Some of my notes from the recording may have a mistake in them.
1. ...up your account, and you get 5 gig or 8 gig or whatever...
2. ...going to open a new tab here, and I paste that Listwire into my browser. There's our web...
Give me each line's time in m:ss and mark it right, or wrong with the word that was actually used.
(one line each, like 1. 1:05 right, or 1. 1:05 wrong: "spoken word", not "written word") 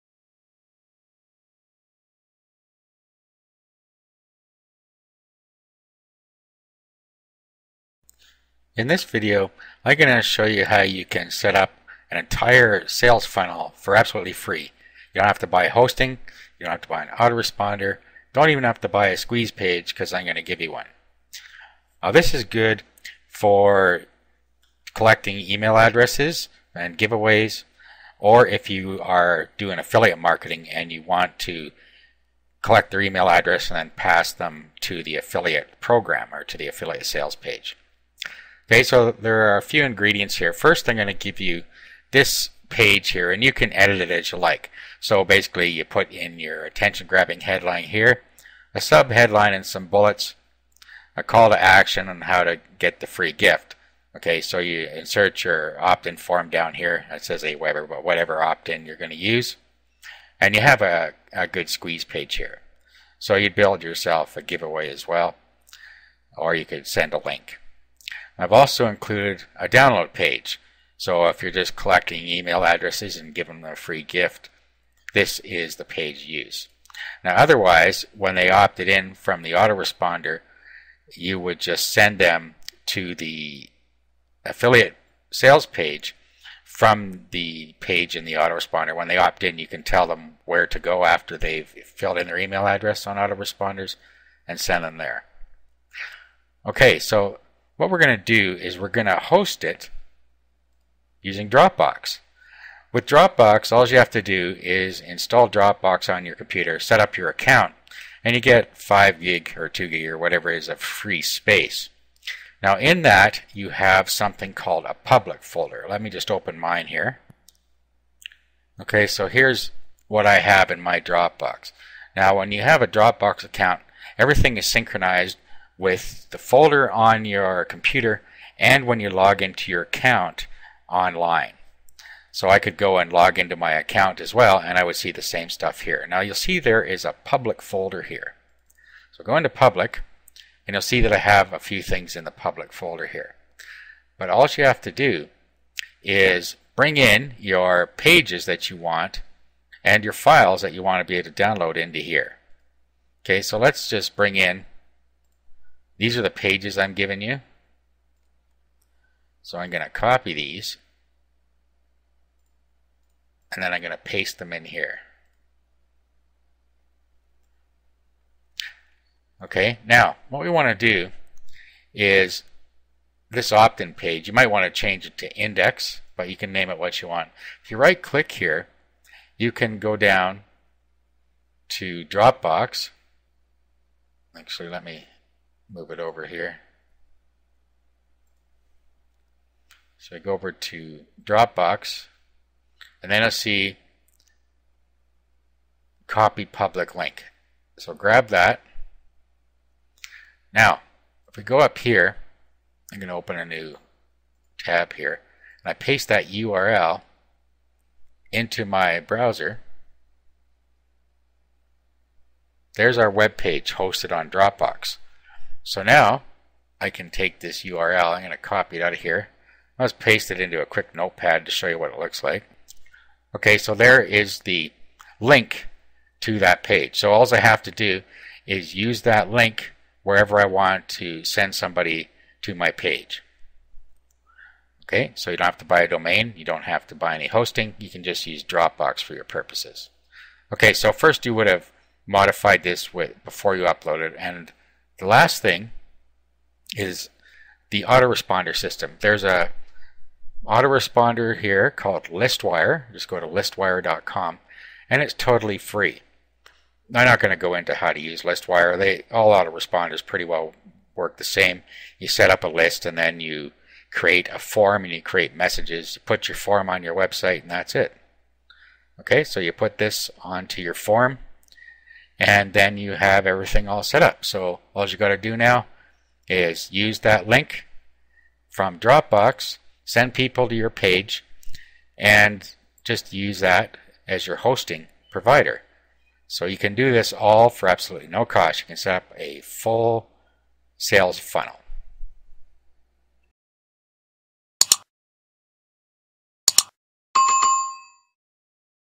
1. 1:46 wrong: "2", not "8"
2. 3:22 wrong: "URL", not "Listwire".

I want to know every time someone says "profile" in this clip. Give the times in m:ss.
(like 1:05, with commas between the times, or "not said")
not said.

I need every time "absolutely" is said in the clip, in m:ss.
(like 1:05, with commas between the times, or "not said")
0:13, 4:47.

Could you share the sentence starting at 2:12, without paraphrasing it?
So I could go and log into my account as well and I would see the same stuff here.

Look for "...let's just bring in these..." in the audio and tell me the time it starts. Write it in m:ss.
2:33.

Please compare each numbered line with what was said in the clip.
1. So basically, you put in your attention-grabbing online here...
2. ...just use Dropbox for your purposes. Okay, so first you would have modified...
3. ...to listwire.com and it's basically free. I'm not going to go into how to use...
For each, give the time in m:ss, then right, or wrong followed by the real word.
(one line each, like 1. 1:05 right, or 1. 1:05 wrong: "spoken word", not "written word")
1. 0:45 wrong: "headline", not "online"
2. 3:58 right
3. 4:13 wrong: "totally", not "basically".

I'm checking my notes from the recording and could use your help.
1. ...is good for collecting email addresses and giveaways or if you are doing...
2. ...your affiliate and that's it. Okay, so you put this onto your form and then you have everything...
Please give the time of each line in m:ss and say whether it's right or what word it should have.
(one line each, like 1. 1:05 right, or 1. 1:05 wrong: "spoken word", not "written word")
1. 0:22 right
2. 4:26 wrong: "website", not "affiliate".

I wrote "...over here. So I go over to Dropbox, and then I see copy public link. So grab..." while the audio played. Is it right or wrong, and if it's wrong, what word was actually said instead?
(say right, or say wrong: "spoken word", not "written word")
right.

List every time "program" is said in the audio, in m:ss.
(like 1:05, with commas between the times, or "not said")
0:35.